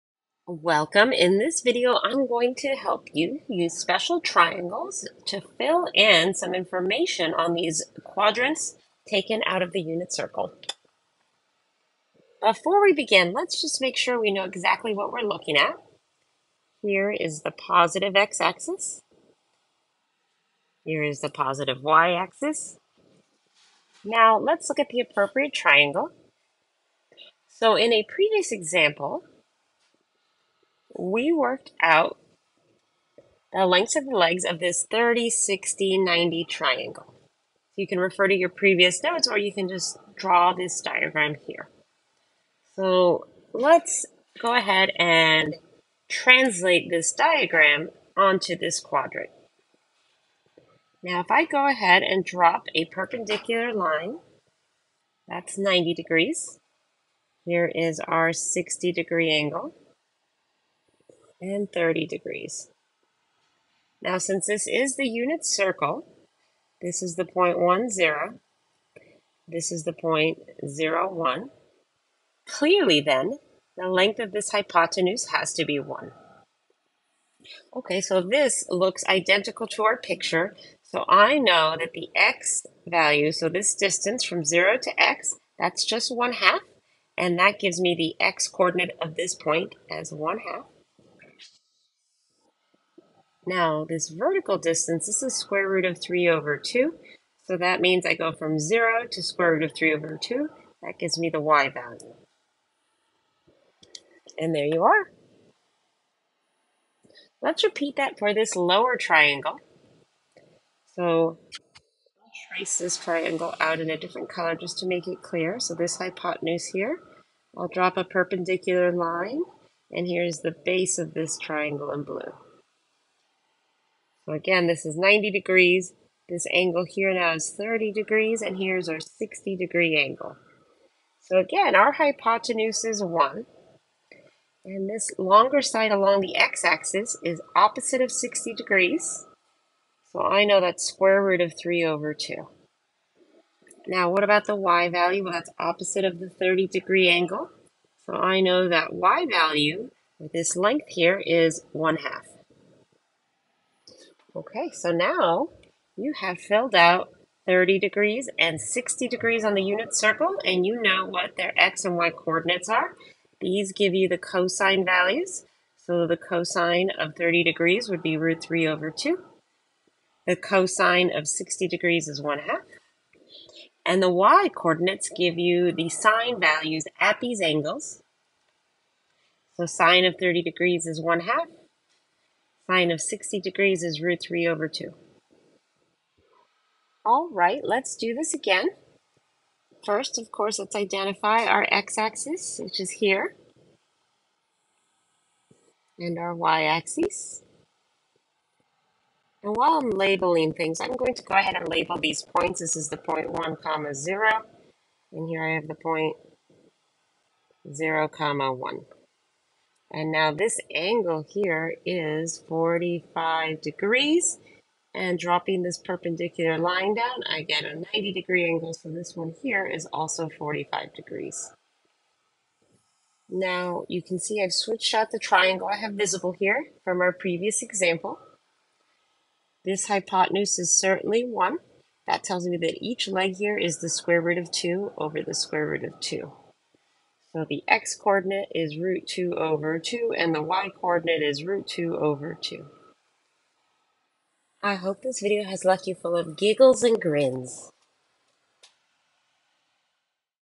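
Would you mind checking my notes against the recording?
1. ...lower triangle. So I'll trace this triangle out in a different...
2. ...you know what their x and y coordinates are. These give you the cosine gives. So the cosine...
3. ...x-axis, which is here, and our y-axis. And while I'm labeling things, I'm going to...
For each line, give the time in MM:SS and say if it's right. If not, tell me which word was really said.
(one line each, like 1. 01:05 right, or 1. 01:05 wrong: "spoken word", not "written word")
1. 01:48 right
2. 02:40 wrong: "values", not "gives"
3. 03:11 right.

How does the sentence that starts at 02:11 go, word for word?
So again, our hypotenuse is 1.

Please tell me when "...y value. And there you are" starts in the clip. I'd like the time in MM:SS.
01:41.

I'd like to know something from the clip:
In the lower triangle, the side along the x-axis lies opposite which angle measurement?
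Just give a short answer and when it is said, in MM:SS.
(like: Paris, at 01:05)
60 degrees, at 02:17.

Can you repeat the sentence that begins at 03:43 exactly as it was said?
Now you can see I've switched out the triangle I have visible here from our previous example.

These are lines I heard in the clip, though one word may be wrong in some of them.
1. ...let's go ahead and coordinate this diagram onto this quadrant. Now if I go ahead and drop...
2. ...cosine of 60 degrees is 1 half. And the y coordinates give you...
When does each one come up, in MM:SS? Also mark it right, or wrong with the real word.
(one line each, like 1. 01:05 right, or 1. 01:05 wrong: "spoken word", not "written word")
1. 00:43 wrong: "translate", not "coordinate"
2. 02:50 right.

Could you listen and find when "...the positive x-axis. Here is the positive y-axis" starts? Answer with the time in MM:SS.
00:17.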